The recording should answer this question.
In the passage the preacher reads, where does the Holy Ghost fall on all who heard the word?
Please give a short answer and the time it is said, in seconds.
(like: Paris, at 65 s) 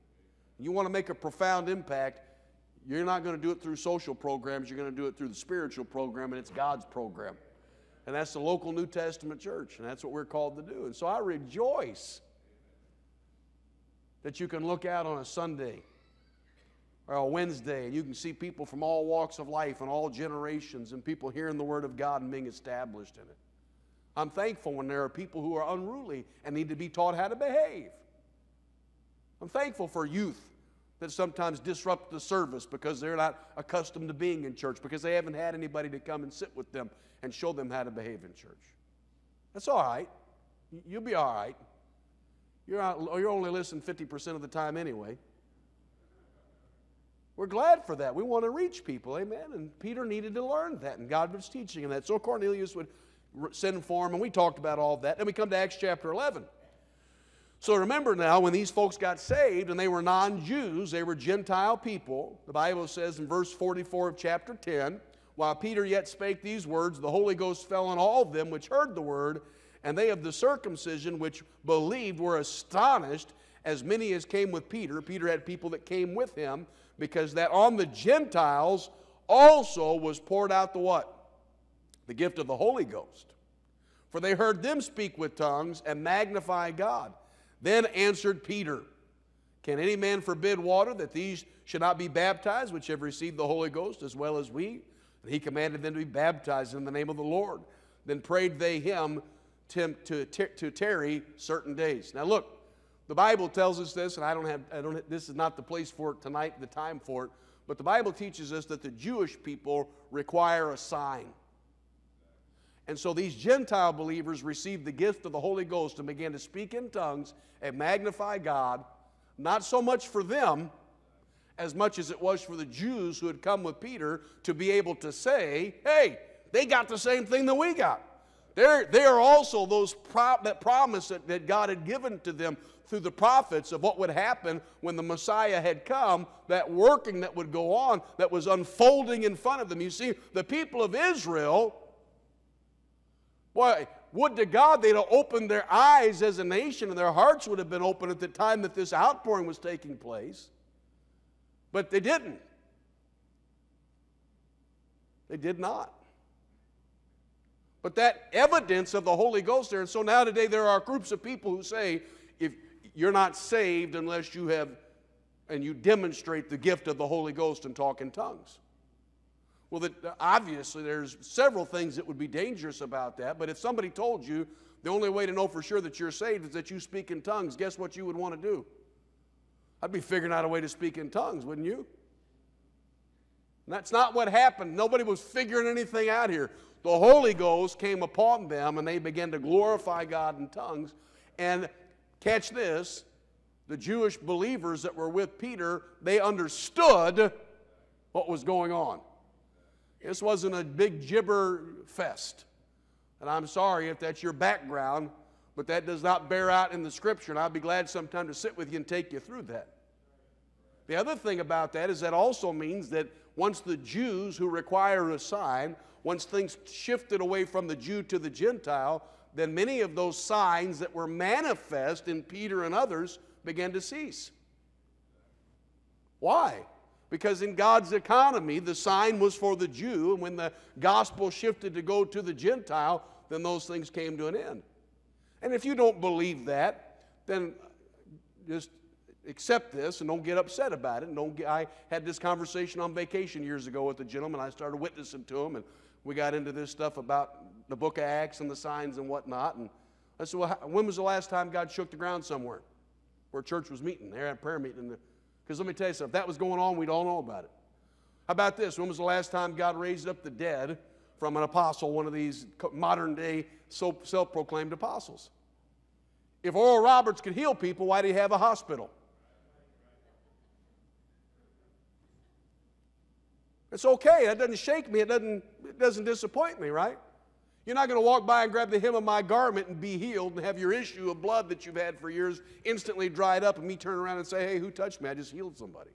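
Verse 44 of chapter 10, at 63 s.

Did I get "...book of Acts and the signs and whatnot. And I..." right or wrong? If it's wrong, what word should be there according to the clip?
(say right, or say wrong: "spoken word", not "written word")
right.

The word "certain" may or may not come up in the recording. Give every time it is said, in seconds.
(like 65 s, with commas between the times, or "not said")
101 s.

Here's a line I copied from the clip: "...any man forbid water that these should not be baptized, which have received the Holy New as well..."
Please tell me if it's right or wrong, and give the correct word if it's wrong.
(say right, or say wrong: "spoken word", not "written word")
wrong: "Ghost", not "New".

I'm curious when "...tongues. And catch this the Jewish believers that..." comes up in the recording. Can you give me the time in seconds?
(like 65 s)
190 s.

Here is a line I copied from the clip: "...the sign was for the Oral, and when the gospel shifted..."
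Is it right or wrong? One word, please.
wrong.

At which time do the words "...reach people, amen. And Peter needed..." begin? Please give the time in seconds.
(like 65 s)
48 s.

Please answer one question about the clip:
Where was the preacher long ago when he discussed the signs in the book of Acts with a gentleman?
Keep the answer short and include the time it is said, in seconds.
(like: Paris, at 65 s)
On vacation, at 242 s.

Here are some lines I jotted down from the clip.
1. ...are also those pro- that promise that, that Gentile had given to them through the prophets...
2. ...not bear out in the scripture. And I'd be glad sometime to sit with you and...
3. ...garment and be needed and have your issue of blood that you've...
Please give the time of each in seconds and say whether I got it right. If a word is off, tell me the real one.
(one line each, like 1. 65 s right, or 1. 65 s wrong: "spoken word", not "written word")
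1. 129 s wrong: "God", not "Gentile"
2. 206 s right
3. 279 s wrong: "healed", not "needed".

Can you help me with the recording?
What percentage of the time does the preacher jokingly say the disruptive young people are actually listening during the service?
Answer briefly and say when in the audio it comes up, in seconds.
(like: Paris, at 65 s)
50%, at 43 s.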